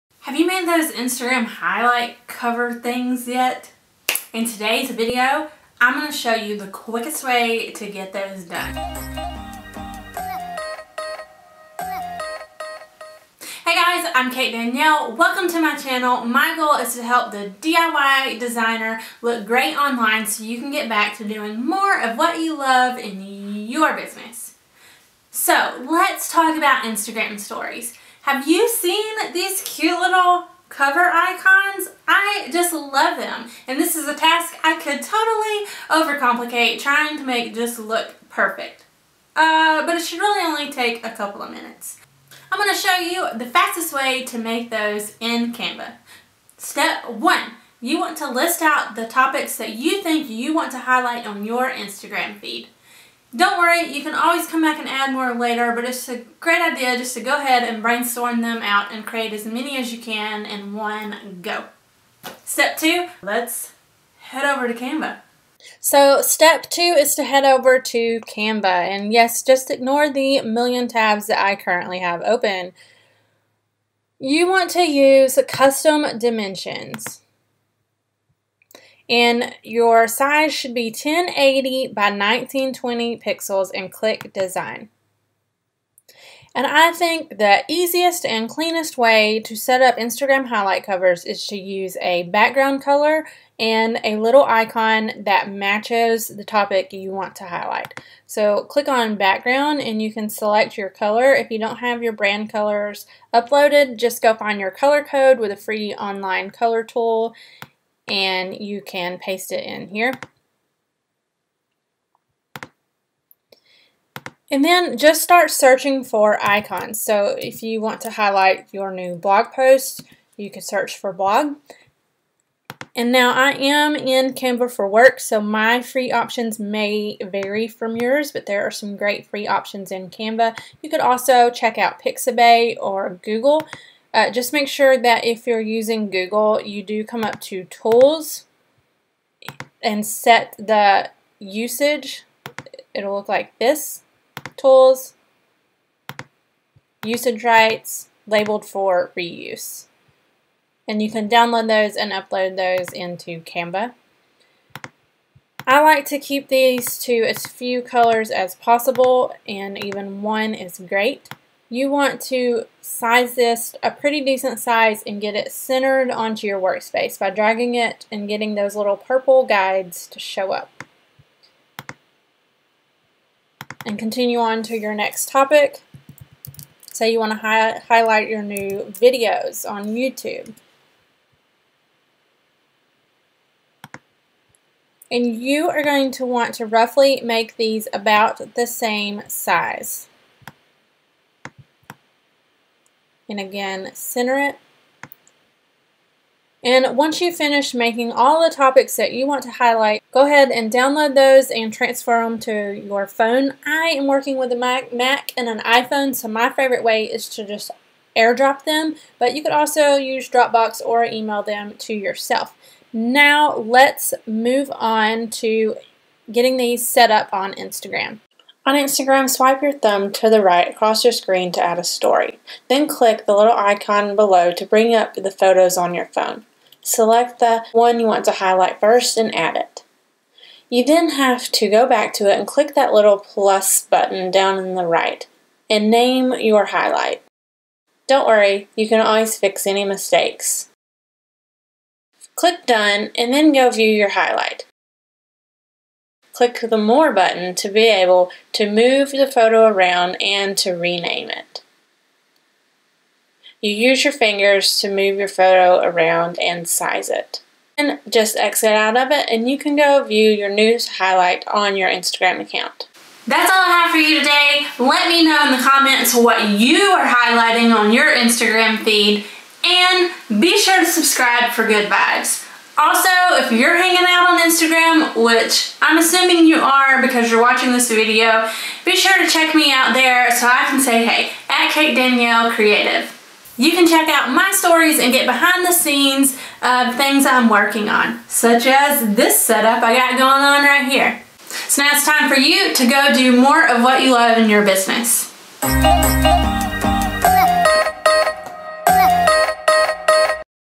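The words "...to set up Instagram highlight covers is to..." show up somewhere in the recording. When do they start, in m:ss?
1:29.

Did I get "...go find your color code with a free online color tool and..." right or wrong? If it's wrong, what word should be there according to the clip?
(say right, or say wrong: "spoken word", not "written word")
right.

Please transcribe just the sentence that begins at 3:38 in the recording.
On Instagram, swipe your thumb to the right across your screen to add a story.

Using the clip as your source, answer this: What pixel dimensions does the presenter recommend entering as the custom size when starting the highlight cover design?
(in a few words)
1080 by 1920.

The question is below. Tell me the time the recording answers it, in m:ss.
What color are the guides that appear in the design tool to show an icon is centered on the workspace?
2:48.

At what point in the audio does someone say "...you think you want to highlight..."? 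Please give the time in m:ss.
0:49.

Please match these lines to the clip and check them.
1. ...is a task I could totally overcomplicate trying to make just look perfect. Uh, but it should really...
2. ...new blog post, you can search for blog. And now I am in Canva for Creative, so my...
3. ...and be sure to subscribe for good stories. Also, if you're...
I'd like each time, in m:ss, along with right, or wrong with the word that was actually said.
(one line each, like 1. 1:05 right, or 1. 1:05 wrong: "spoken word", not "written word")
1. 0:33 right
2. 1:58 wrong: "Work", not "Creative"
3. 4:29 wrong: "vibes", not "stories".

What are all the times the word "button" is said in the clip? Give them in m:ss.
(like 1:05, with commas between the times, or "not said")
3:53, 4:07.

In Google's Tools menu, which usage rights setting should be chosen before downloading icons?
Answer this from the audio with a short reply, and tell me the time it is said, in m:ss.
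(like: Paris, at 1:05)
labeled for reuse, at 2:28.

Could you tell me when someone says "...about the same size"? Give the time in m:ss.
3:07.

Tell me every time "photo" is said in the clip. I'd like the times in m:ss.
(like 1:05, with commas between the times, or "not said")
3:45, 4:09, 4:15.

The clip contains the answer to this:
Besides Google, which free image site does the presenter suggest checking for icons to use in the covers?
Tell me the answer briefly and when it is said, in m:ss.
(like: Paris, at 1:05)
Pixabay, at 2:12.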